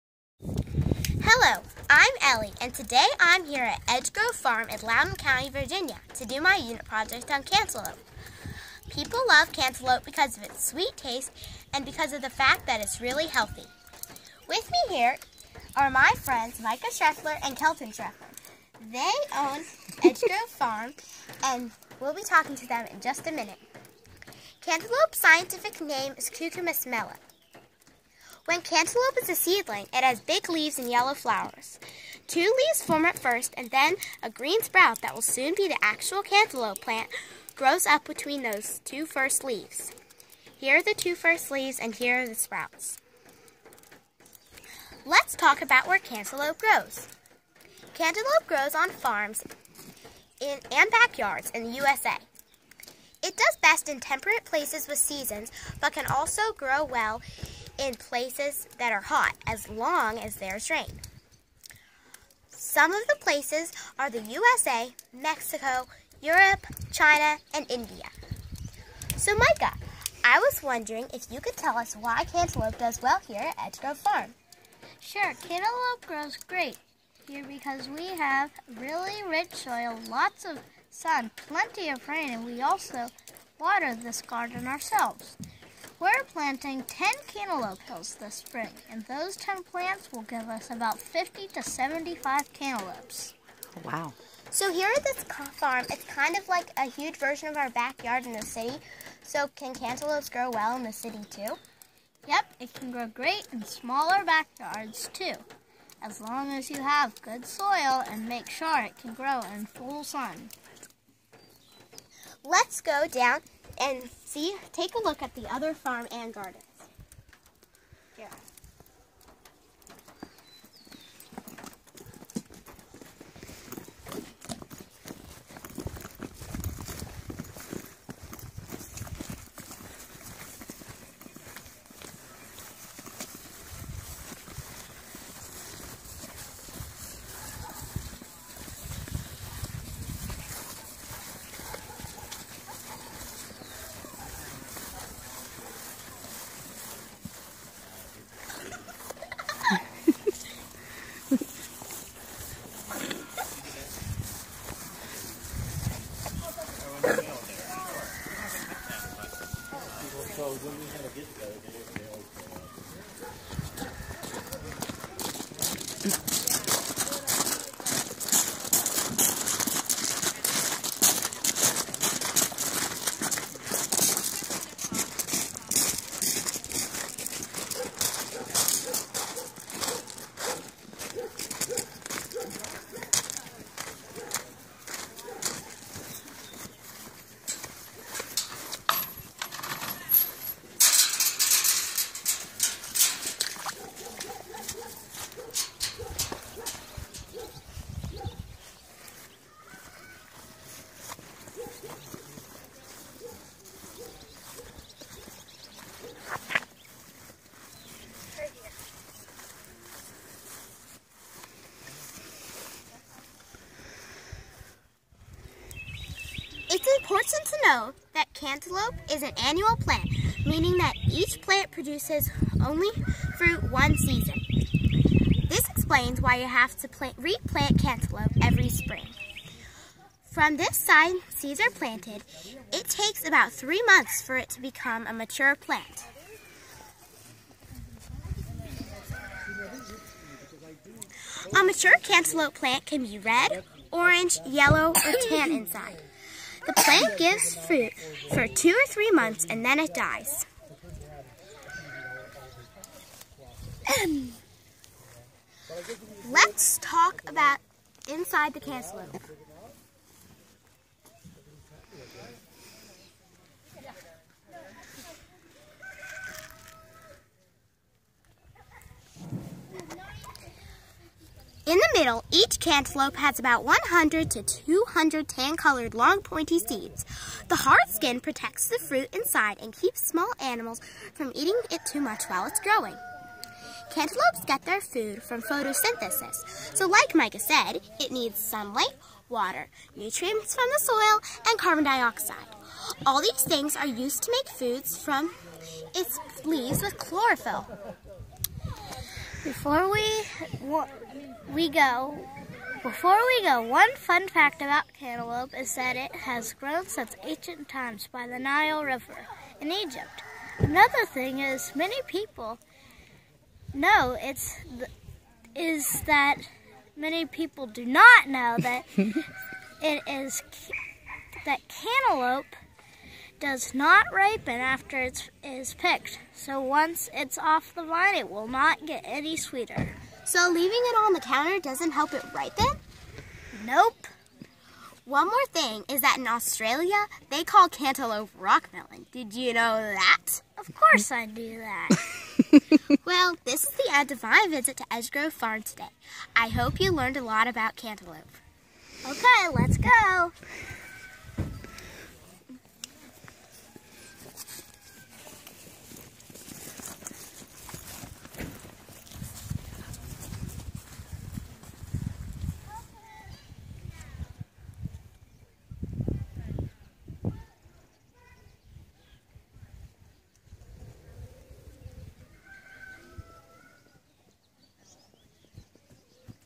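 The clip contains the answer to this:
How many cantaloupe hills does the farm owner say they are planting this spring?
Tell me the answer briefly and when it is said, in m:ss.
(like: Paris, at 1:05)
10, at 1:26.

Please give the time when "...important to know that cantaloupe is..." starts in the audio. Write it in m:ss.
3:36.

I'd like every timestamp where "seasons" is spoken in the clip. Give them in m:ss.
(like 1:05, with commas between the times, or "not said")
0:54, 3:43.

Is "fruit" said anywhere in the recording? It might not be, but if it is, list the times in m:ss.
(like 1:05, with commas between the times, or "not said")
3:43, 4:07, 4:38.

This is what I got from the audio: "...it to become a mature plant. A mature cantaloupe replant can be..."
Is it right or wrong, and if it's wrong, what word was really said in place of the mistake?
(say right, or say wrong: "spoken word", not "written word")
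wrong: "plant", not "replant".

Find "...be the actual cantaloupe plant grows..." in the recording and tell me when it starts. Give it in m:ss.
0:35.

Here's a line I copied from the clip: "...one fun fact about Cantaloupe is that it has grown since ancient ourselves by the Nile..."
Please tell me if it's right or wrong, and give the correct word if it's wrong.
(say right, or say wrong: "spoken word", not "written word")
wrong: "times", not "ourselves".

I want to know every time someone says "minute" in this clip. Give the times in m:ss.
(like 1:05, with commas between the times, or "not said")
0:23.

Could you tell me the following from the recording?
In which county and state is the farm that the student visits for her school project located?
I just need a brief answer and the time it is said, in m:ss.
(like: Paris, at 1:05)
Loudoun County, Virginia, at 0:04.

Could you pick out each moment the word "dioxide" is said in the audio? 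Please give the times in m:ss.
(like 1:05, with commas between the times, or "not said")
4:51.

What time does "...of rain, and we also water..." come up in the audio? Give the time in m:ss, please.
1:21.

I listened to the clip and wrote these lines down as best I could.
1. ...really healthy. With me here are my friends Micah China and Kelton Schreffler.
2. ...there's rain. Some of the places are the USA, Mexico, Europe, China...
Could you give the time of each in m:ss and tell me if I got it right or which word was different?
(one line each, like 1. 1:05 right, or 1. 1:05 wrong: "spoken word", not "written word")
1. 0:13 wrong: "Schreffler", not "China"
2. 1:00 right.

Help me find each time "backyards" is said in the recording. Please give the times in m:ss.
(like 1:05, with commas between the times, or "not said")
0:50, 1:37, 1:44.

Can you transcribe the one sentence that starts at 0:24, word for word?
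Cantaloupe's scientific name is Cucumis melon.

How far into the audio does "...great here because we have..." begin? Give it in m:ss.
1:16.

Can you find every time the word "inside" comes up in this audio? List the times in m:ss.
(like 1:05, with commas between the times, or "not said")
4:05, 4:18, 4:39.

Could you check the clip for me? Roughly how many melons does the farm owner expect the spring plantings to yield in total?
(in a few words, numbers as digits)
50 to 75.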